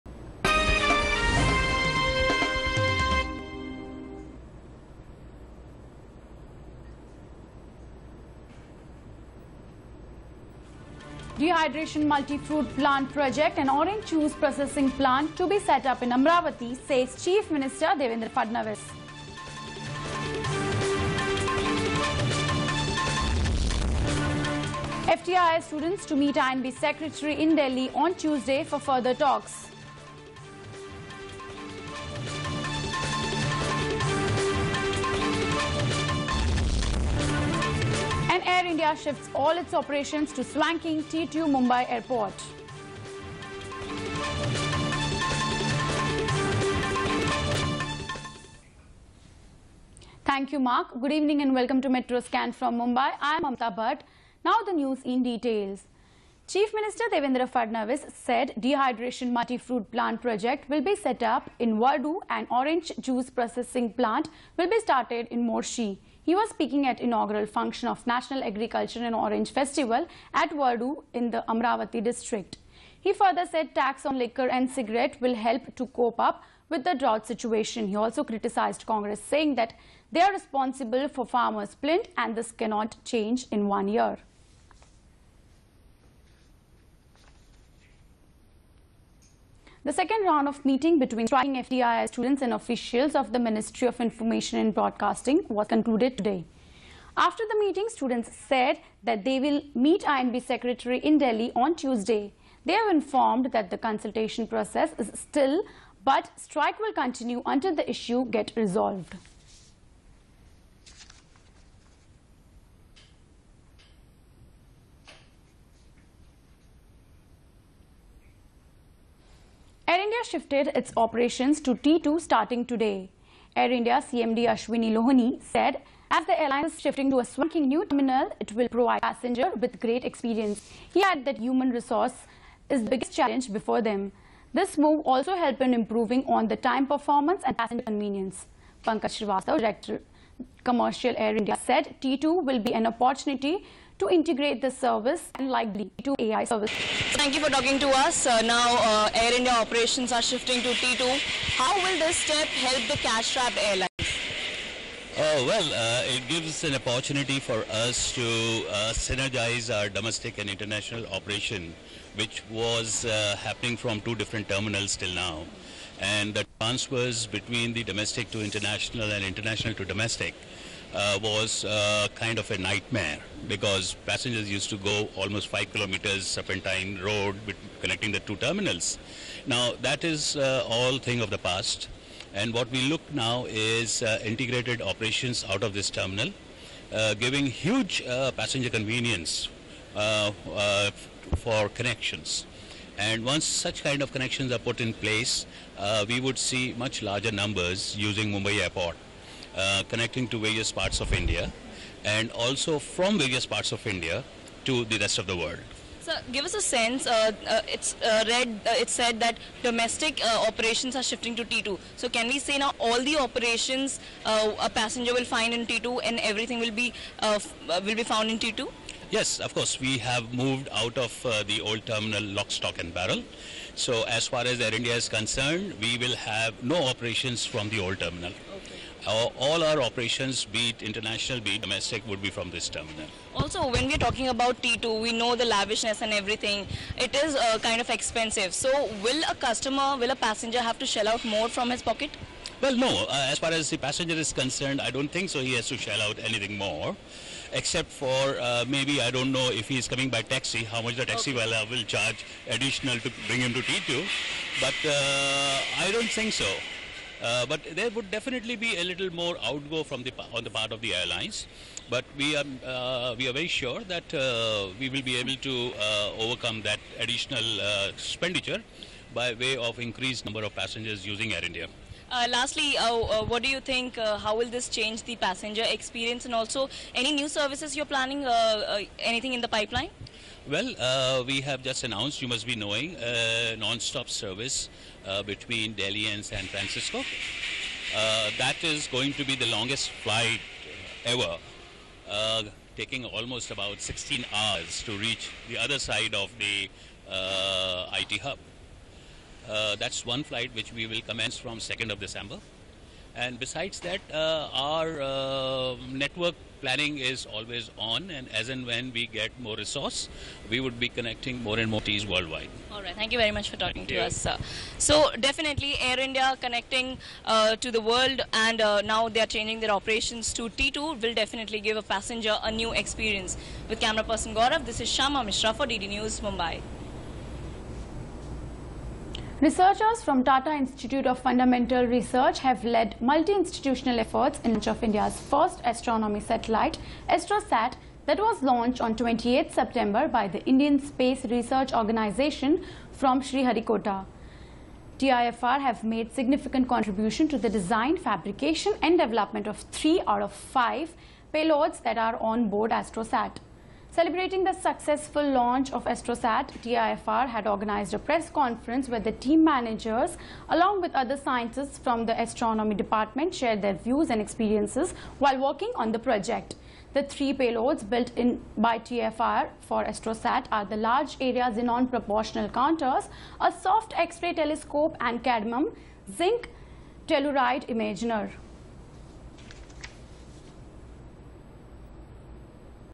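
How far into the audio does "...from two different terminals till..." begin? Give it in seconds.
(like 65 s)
163 s.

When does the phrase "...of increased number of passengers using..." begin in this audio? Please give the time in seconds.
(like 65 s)
269 s.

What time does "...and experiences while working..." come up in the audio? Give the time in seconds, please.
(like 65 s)
364 s.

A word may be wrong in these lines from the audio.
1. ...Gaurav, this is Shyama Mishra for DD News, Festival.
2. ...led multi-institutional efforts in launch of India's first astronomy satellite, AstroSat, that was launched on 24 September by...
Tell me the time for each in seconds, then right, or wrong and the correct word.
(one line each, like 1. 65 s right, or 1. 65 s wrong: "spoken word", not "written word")
1. 324 s wrong: "Mumbai", not "Festival"
2. 332 s wrong: "28", not "24".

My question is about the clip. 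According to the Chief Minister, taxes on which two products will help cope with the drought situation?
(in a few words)
Liquor and cigarette.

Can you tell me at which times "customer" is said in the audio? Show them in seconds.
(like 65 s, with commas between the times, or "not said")
239 s.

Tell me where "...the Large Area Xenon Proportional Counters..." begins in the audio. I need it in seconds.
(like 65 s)
370 s.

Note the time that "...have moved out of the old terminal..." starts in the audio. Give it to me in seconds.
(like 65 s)
219 s.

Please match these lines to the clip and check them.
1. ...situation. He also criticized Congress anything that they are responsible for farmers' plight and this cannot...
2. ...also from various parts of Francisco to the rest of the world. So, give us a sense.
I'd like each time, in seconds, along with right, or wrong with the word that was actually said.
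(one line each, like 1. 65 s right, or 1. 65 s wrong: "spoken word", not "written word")
1. 77 s wrong: "saying", not "anything"
2. 202 s wrong: "India", not "Francisco".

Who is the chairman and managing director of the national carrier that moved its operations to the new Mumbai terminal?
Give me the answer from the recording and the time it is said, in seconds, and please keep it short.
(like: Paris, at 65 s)
Ashwini Lohani, at 124 s.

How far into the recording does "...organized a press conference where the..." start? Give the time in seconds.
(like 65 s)
357 s.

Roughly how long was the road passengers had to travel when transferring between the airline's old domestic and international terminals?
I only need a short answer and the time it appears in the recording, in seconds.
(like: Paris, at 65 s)
5 kilometers, at 175 s.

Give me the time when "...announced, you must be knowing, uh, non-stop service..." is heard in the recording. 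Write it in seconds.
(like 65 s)
281 s.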